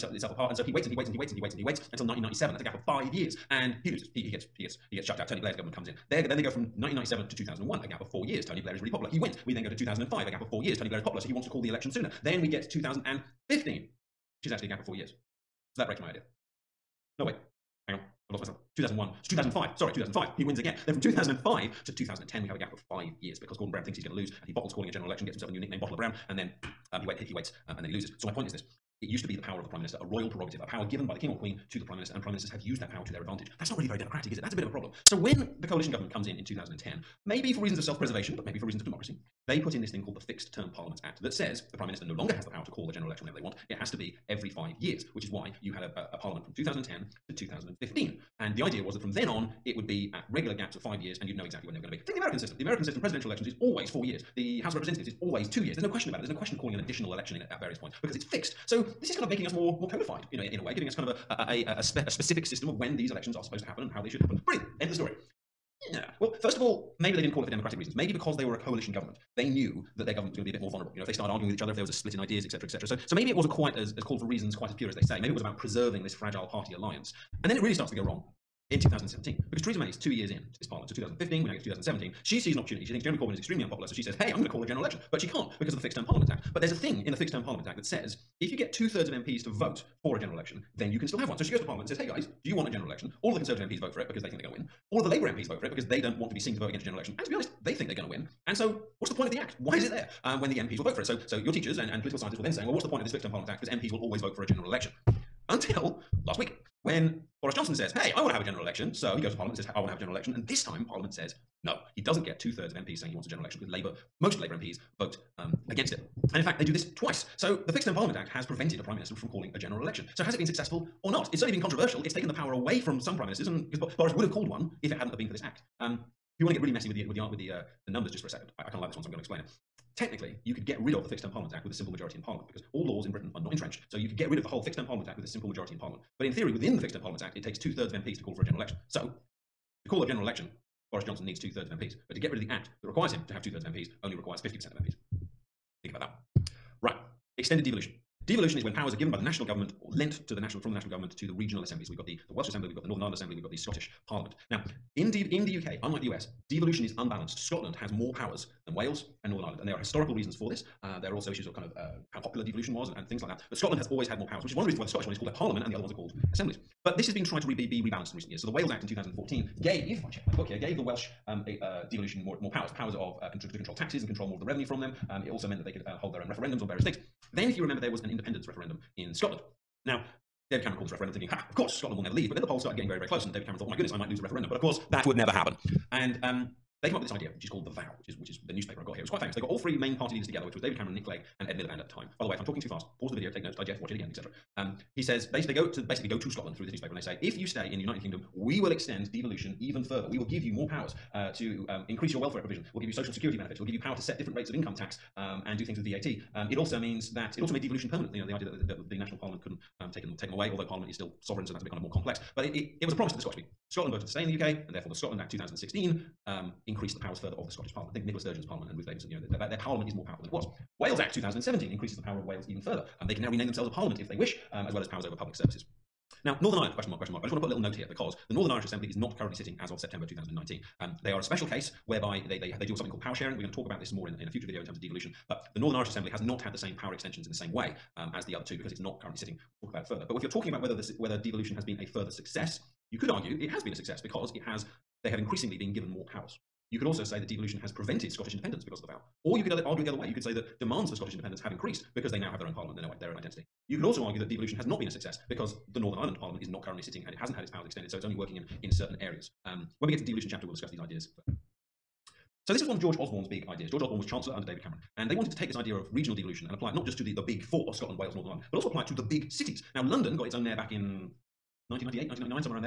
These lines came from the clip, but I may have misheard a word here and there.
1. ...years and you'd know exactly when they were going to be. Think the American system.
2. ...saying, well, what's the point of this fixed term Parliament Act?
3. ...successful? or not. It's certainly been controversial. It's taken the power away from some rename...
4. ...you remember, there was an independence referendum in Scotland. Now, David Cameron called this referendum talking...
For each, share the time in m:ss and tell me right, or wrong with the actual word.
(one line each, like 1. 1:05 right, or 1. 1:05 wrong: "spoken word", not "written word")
1. 0:51 right
2. 1:42 right
3. 2:00 wrong: "prime", not "rename"
4. 2:57 wrong: "thinking", not "talking".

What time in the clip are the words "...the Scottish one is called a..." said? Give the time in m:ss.
2:44.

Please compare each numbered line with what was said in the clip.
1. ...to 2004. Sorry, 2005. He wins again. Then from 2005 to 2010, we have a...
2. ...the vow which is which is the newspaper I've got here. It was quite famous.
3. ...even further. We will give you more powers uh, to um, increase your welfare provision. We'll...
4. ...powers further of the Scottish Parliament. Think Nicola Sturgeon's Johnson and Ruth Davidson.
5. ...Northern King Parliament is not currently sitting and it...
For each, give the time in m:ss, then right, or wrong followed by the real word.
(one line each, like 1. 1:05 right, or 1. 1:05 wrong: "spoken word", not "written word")
1. 0:19 wrong: "2005", not "2004"
2. 3:07 right
3. 3:19 right
4. 3:36 wrong: "Parliament", not "Johnson"
5. 4:15 wrong: "Ireland", not "King".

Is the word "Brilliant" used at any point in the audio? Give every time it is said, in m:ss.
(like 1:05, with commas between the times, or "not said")
1:04.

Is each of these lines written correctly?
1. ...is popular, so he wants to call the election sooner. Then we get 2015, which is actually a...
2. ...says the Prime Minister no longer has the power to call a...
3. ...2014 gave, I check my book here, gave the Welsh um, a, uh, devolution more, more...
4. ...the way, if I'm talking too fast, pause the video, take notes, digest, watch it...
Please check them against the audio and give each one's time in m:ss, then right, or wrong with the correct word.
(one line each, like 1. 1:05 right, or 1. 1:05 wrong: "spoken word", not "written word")
1. 0:10 right
2. 0:41 right
3. 2:48 right
4. 3:12 right.